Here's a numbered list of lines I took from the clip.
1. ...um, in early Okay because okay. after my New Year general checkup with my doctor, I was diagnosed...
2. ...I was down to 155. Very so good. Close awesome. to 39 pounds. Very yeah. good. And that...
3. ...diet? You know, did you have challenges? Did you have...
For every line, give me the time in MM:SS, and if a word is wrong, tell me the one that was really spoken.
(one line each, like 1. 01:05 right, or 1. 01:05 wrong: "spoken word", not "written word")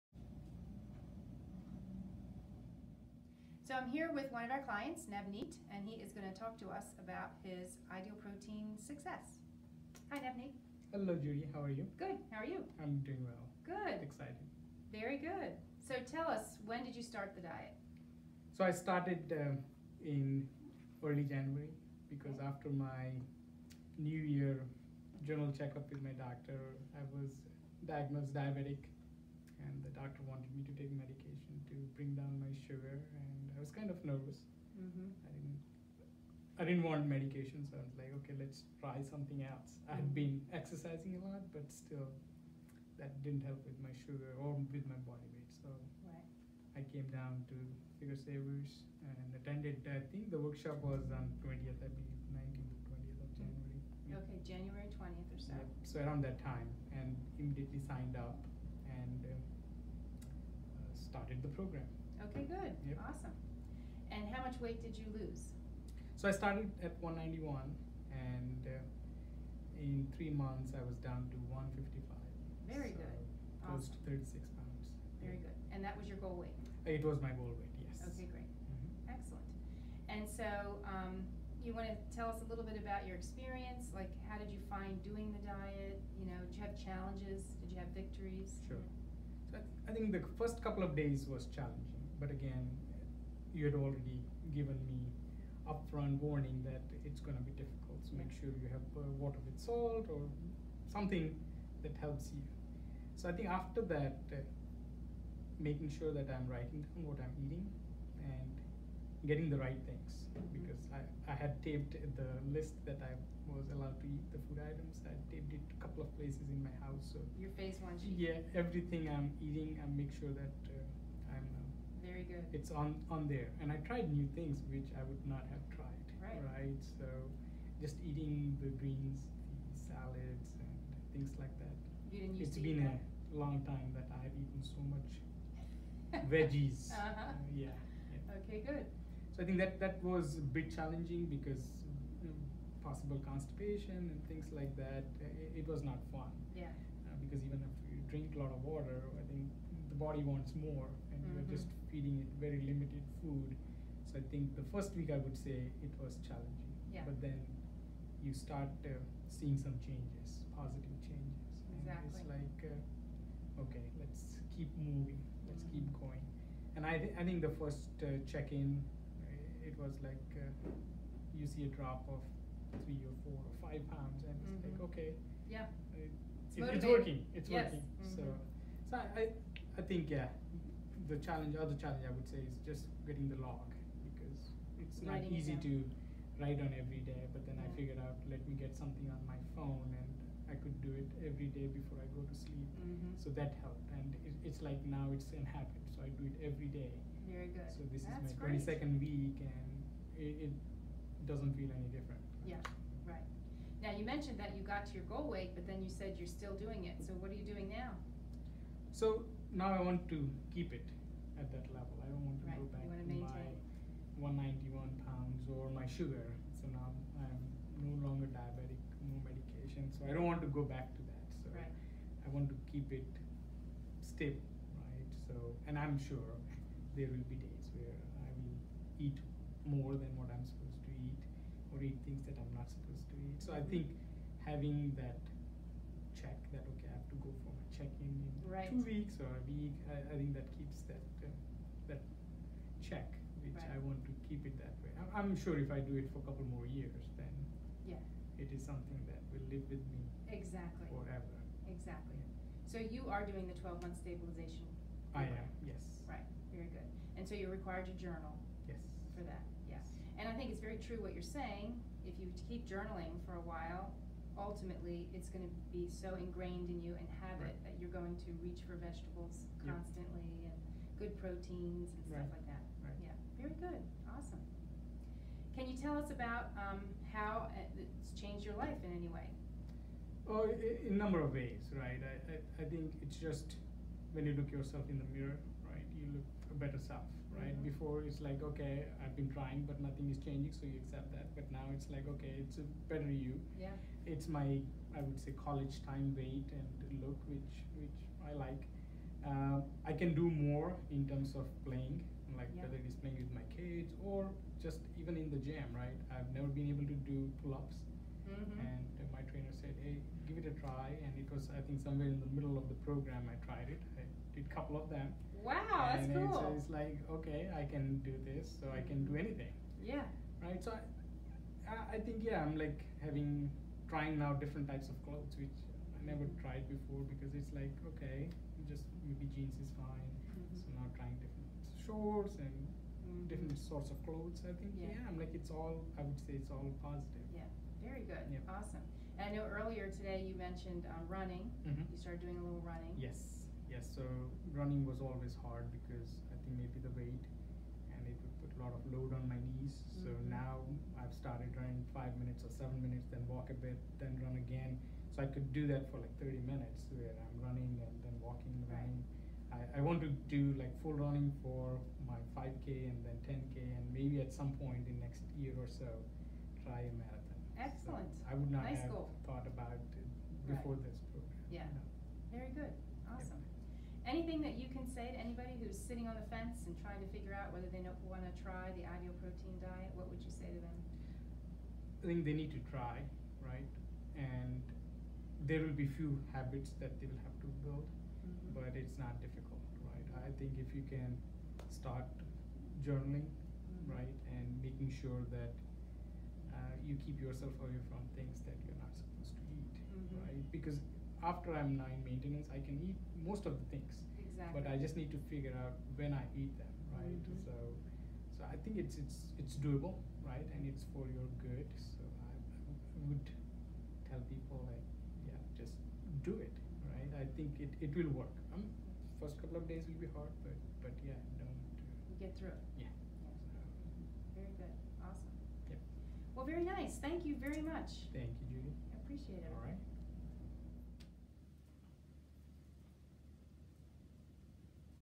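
1. 00:19 wrong: "January", not "Okay"
2. 01:10 wrong: "36", not "39"
3. 01:25 right.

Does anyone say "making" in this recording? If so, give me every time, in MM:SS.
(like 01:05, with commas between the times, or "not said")
01:45, 06:34.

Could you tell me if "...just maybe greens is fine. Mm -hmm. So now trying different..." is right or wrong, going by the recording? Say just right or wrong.
wrong.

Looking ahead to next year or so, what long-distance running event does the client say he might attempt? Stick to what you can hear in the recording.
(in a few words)
A marathon.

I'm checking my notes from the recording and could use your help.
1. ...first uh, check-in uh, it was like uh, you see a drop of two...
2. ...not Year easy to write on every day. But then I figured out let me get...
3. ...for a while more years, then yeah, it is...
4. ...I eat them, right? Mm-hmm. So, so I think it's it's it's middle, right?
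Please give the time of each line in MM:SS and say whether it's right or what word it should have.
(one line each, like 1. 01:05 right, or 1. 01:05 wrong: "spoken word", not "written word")
1. 02:47 wrong: "three", not "two"
2. 03:05 wrong: "Writing", not "Year"
3. 04:06 wrong: "couple", not "while"
4. 06:46 wrong: "doable", not "middle".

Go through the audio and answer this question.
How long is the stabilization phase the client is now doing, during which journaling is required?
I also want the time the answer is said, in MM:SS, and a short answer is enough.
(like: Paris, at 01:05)
12 months, at 04:13.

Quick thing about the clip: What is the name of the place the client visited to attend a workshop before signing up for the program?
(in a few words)
Figure Savers.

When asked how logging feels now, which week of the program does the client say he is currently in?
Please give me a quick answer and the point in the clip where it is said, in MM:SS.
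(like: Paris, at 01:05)
22nd week, at 03:18.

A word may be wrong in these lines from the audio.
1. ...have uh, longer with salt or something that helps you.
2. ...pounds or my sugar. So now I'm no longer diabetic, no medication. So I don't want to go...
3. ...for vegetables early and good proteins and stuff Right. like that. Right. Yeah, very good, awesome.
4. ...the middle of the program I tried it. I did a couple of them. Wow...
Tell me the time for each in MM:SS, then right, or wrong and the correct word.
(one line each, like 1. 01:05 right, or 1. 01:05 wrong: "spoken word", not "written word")
1. 01:38 wrong: "water", not "longer"
2. 03:35 right
3. 04:28 wrong: "constantly", not "early"
4. 05:12 right.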